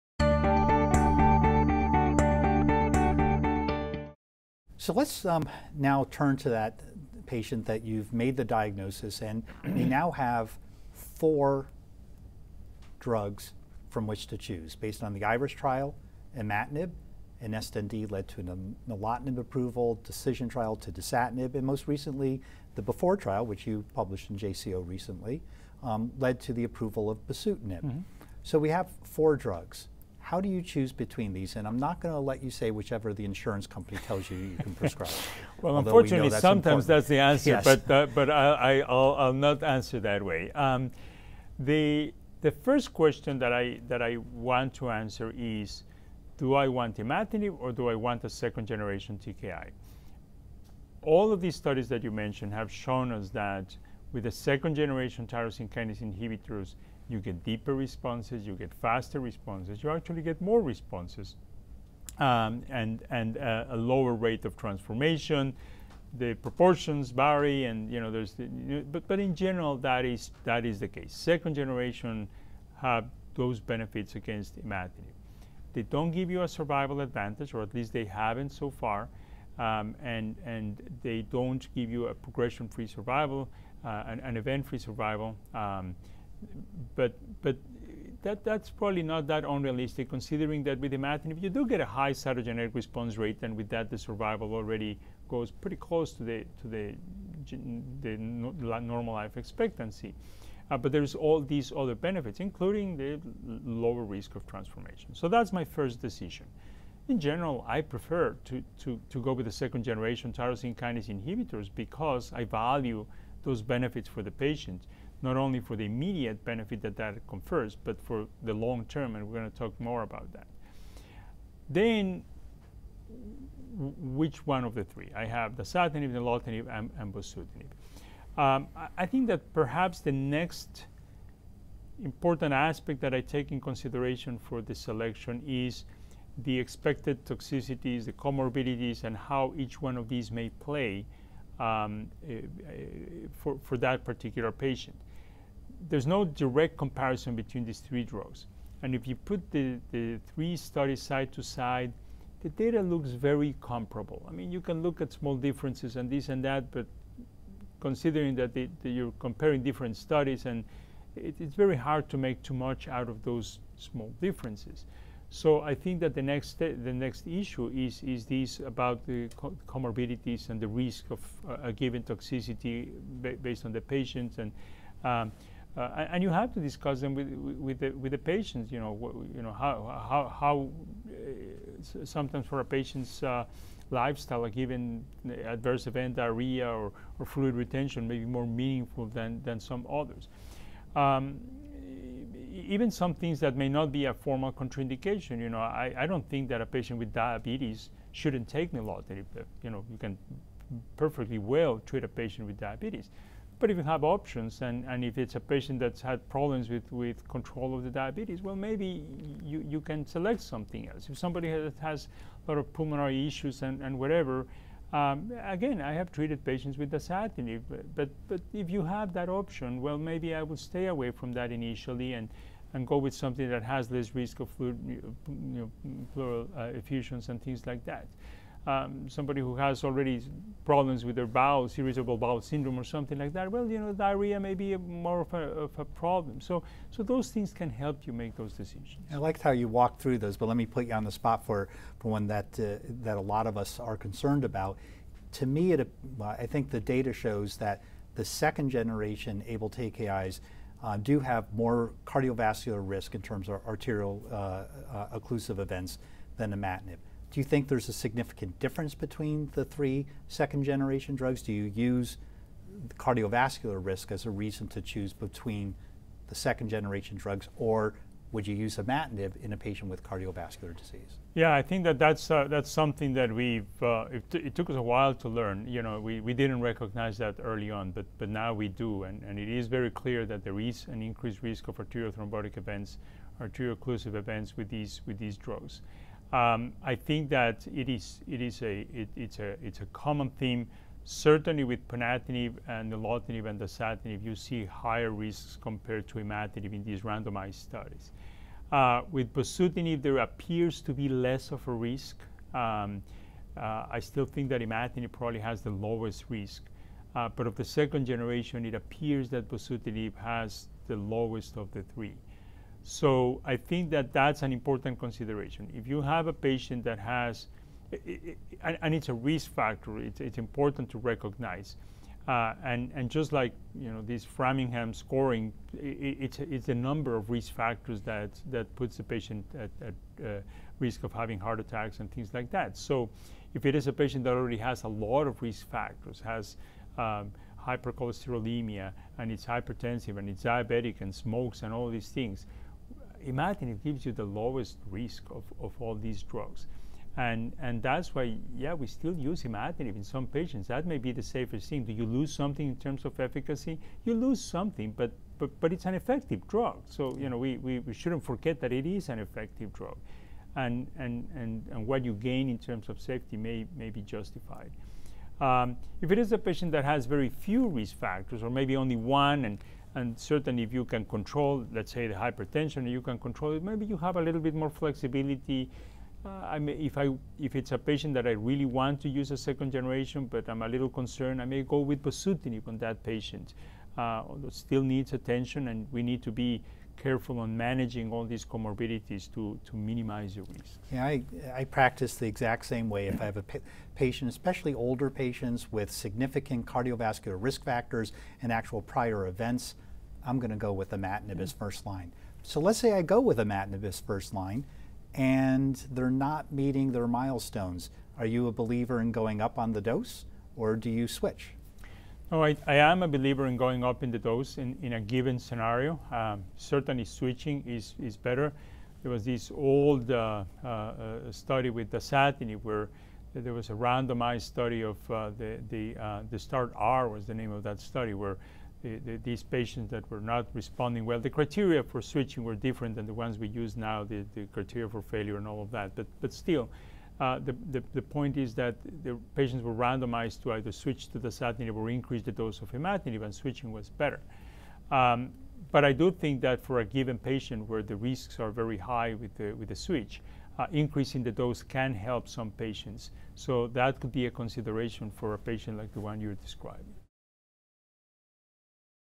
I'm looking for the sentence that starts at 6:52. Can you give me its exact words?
I, I, am a believer in going up in the dose in, in a given scenario.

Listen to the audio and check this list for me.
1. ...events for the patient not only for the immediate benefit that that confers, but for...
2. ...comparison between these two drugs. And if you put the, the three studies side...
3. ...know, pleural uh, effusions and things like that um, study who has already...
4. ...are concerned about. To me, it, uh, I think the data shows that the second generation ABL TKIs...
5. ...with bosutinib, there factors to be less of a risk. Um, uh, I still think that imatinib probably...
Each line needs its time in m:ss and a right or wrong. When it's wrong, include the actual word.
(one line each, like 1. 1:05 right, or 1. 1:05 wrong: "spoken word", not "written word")
1. 1:53 wrong: "benefits", not "events"
2. 2:26 wrong: "three", not "two"
3. 3:45 wrong: "somebody", not "study"
4. 4:03 right
5. 4:59 wrong: "appears", not "factors".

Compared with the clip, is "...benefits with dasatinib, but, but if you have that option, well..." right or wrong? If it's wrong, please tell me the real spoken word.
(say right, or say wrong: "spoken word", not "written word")
wrong: "patients", not "benefits".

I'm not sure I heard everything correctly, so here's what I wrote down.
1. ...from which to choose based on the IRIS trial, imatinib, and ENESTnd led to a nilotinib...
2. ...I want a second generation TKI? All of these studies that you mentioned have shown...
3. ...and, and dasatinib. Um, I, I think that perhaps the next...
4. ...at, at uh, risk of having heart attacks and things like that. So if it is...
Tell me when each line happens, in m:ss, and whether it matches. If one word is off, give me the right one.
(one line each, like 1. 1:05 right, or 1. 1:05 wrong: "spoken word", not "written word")
1. 0:13 right
2. 0:47 right
3. 2:06 wrong: "bosutinib", not "dasatinib"
4. 5:29 right.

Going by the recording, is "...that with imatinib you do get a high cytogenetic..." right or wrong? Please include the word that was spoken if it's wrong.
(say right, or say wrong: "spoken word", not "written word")
right.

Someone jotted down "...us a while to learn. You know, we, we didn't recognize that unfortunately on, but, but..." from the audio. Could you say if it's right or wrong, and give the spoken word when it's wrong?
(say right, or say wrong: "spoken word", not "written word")
wrong: "early", not "unfortunately".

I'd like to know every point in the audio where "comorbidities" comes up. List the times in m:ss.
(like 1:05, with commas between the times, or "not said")
2:18, 2:49, 6:28.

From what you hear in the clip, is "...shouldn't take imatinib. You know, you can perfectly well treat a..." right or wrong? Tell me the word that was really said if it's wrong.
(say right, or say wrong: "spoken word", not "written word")
wrong: "nilotinib", not "imatinib".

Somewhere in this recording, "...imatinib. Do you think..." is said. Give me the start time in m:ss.
4:16.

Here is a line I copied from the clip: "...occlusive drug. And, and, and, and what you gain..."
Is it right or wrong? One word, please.
wrong.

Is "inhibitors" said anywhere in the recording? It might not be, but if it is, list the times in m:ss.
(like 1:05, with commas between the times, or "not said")
0:56, 1:51.